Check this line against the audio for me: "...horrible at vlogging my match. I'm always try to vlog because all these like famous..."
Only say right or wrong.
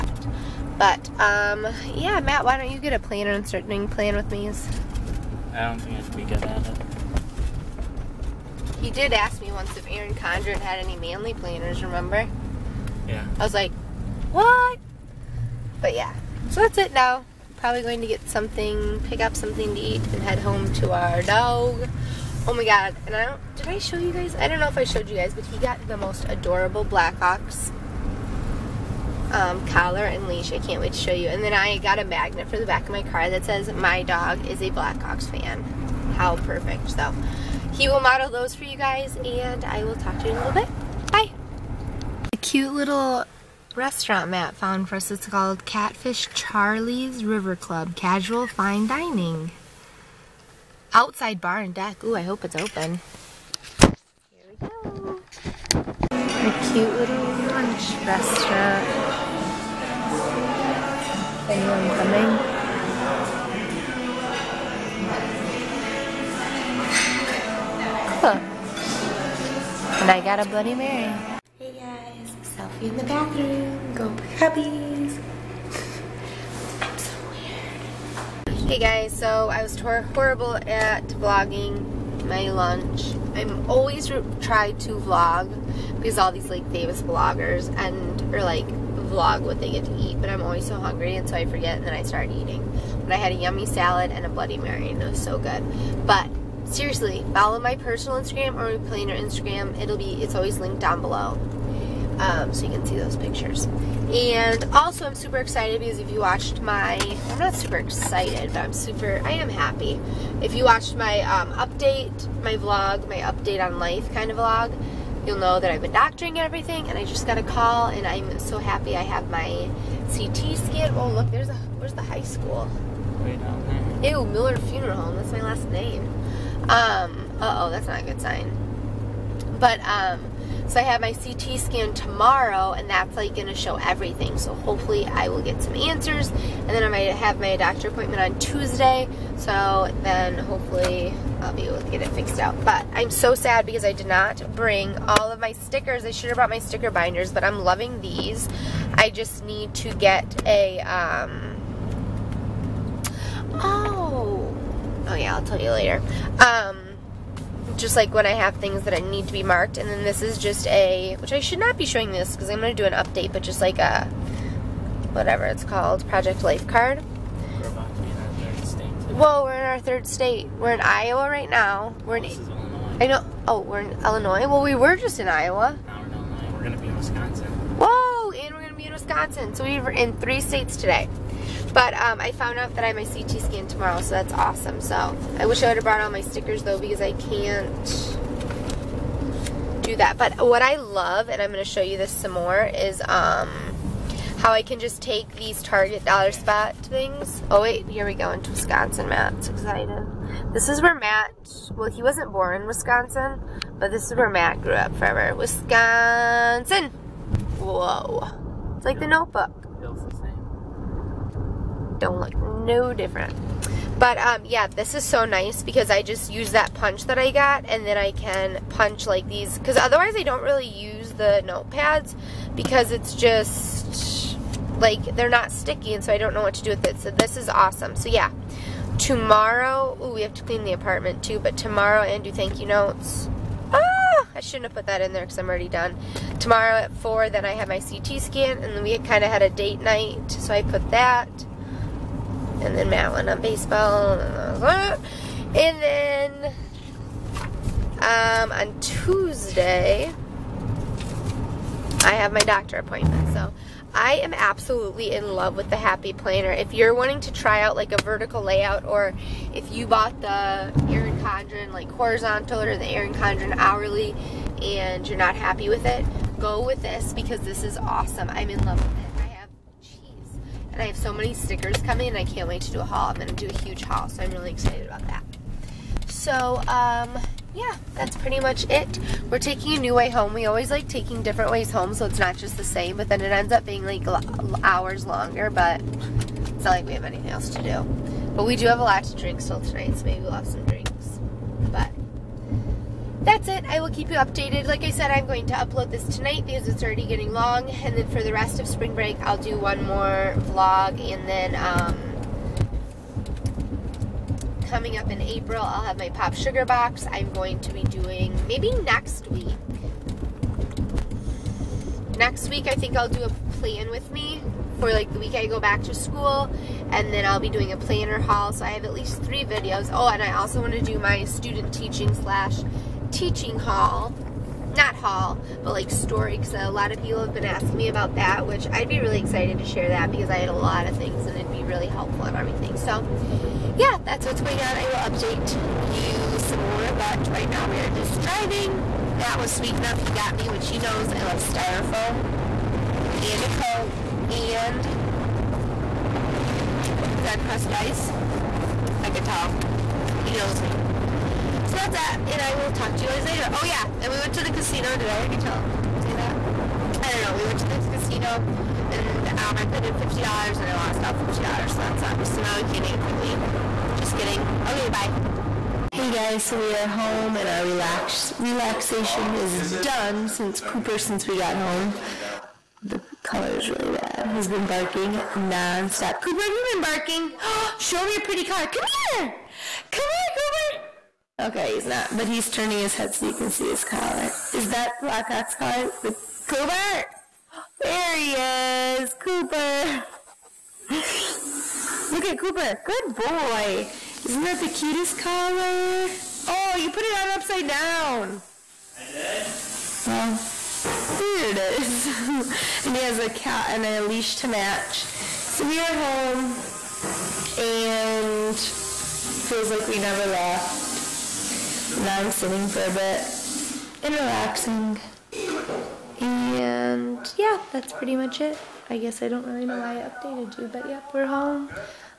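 wrong.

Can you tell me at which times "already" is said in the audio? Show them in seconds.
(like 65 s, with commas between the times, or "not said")
235 s, 296 s, 355 s.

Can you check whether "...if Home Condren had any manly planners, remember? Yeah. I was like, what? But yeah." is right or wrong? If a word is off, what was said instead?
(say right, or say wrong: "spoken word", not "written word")
wrong: "Erin", not "Home".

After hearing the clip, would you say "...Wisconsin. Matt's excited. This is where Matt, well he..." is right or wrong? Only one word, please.
right.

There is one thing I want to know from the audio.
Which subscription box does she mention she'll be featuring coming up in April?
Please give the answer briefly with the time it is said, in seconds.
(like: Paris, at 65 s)
Pop Sugar box, at 306 s.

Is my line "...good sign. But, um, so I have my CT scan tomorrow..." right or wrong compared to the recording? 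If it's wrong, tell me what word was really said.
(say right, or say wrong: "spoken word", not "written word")
right.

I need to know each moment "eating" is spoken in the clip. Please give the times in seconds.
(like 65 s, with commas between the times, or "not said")
92 s.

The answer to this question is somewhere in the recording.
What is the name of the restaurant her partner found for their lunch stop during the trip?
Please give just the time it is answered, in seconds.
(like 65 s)
45 s.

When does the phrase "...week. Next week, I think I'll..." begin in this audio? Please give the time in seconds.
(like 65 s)
309 s.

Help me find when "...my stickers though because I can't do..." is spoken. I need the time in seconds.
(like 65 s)
186 s.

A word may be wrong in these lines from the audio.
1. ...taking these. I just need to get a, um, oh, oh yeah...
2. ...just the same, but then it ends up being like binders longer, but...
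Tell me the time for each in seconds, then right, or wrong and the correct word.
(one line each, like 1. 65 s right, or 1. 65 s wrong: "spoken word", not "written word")
1. 147 s wrong: "loving", not "taking"
2. 282 s wrong: "hours", not "binders".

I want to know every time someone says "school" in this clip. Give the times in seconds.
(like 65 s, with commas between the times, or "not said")
122 s, 315 s.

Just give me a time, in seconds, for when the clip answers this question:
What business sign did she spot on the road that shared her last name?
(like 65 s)
124 s.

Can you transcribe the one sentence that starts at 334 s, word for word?
I will update you some more, but right now we are just driving.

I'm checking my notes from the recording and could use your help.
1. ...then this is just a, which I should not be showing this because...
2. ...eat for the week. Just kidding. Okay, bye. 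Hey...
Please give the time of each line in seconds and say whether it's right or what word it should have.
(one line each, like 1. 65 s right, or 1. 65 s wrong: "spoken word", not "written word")
1. 159 s right
2. 362 s right.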